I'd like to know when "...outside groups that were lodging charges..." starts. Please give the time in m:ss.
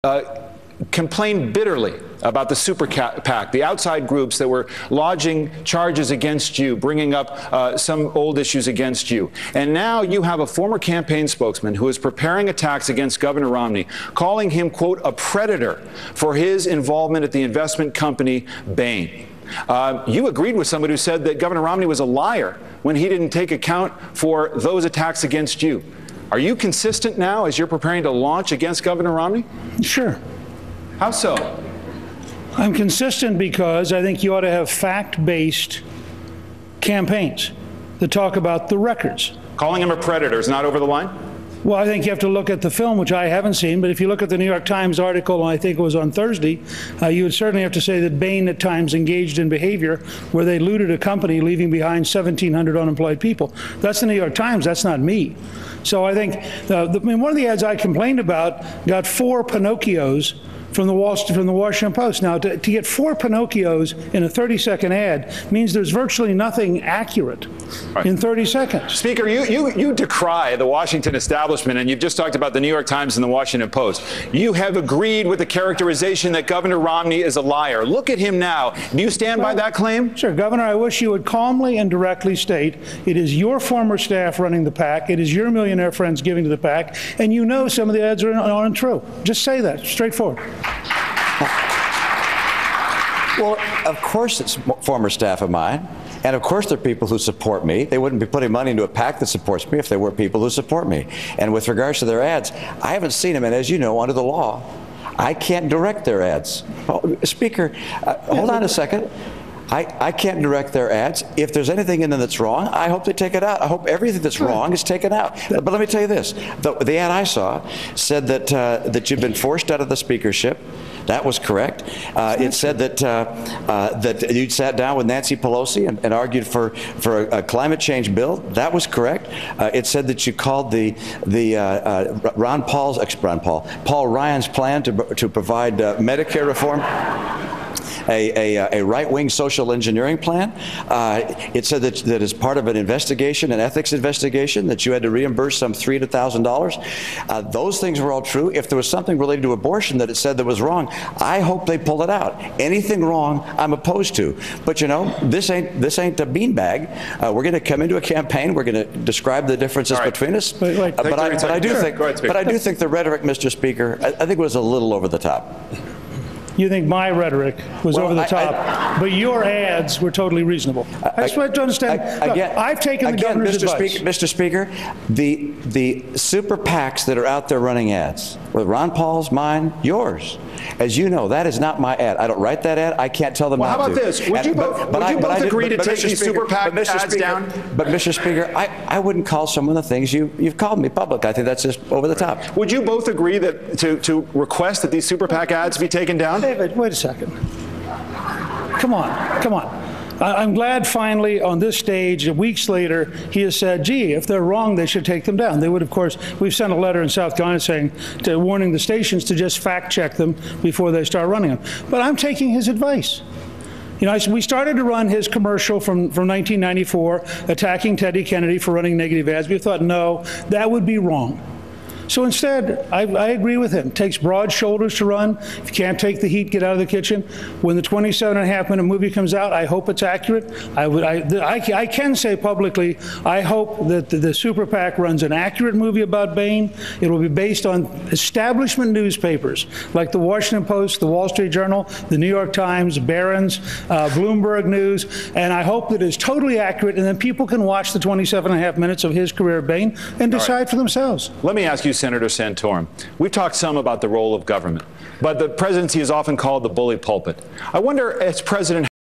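0:03.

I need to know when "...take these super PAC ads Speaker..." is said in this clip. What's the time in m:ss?
3:05.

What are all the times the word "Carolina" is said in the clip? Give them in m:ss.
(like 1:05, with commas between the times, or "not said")
3:27.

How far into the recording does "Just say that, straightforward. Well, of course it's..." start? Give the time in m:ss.
1:29.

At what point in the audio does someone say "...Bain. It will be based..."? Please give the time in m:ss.
3:56.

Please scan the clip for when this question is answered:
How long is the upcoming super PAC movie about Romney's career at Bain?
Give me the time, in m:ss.
3:47.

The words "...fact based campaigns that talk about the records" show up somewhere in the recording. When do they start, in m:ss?
0:34.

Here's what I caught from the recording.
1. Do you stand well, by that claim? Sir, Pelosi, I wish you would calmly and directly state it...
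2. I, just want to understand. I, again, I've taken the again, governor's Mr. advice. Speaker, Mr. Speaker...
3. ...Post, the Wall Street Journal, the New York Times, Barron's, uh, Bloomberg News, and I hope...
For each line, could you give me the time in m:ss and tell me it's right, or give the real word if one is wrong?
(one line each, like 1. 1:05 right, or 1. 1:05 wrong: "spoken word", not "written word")
1. 1:18 wrong: "Governor", not "Pelosi"
2. 2:51 right
3. 4:00 right.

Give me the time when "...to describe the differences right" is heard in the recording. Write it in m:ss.
2:38.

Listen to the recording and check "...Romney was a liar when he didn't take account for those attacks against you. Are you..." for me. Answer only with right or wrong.
right.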